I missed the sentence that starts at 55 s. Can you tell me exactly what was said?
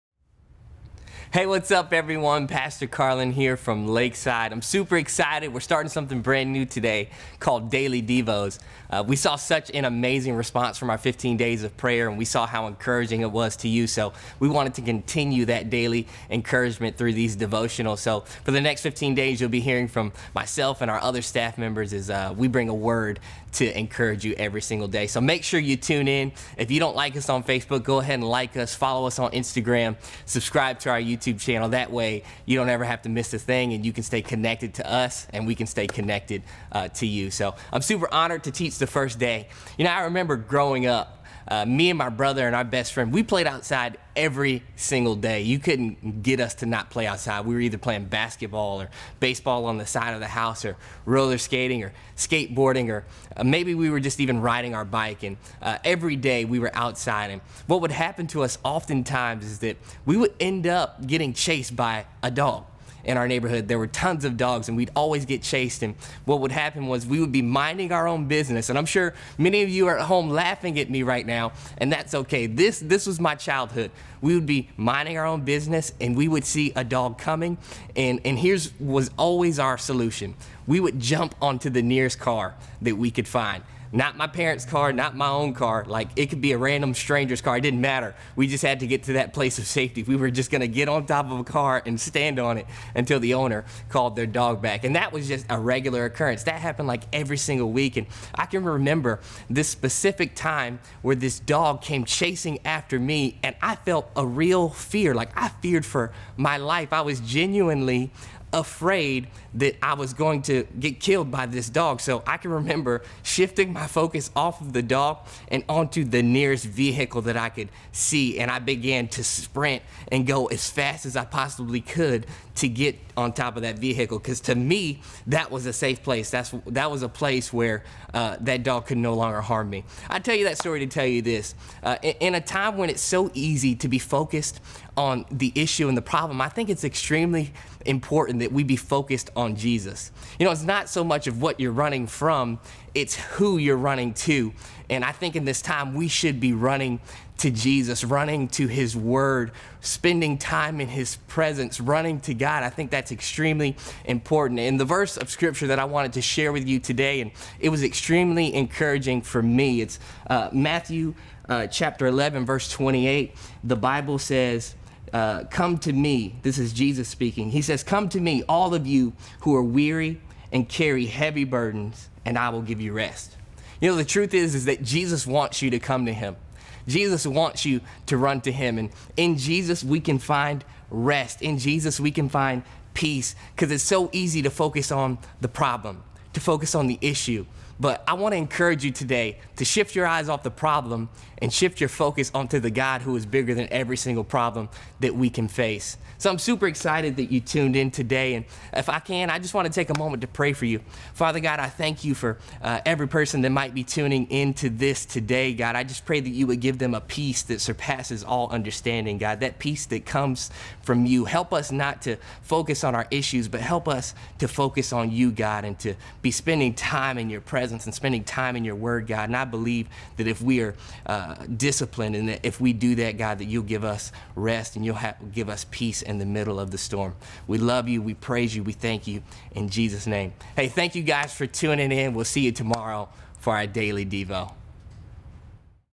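And uh, every day we were outside.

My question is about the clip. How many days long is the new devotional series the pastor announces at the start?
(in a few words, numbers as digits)
15.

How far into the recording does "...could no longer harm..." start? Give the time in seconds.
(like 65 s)
128 s.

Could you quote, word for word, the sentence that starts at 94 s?
And that was just a regular occurrence.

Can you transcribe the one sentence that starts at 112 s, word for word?
So I can remember shifting my focus off of the dog and onto the nearest vehicle that I could see.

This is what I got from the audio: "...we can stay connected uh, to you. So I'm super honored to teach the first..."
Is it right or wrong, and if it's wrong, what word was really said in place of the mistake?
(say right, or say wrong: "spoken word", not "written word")
right.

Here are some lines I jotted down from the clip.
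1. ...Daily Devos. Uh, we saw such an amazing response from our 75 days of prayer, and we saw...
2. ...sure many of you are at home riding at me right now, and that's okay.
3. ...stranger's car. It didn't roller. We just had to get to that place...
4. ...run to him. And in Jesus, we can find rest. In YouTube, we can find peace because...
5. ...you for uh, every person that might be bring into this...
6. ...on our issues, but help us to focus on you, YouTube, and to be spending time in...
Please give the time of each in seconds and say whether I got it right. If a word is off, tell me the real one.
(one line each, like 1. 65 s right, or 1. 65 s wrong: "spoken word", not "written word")
1. 7 s wrong: "15", not "75"
2. 68 s wrong: "laughing", not "riding"
3. 86 s wrong: "matter", not "roller"
4. 178 s wrong: "Jesus", not "YouTube"
5. 202 s wrong: "tuning", not "bring"
6. 212 s wrong: "God", not "YouTube".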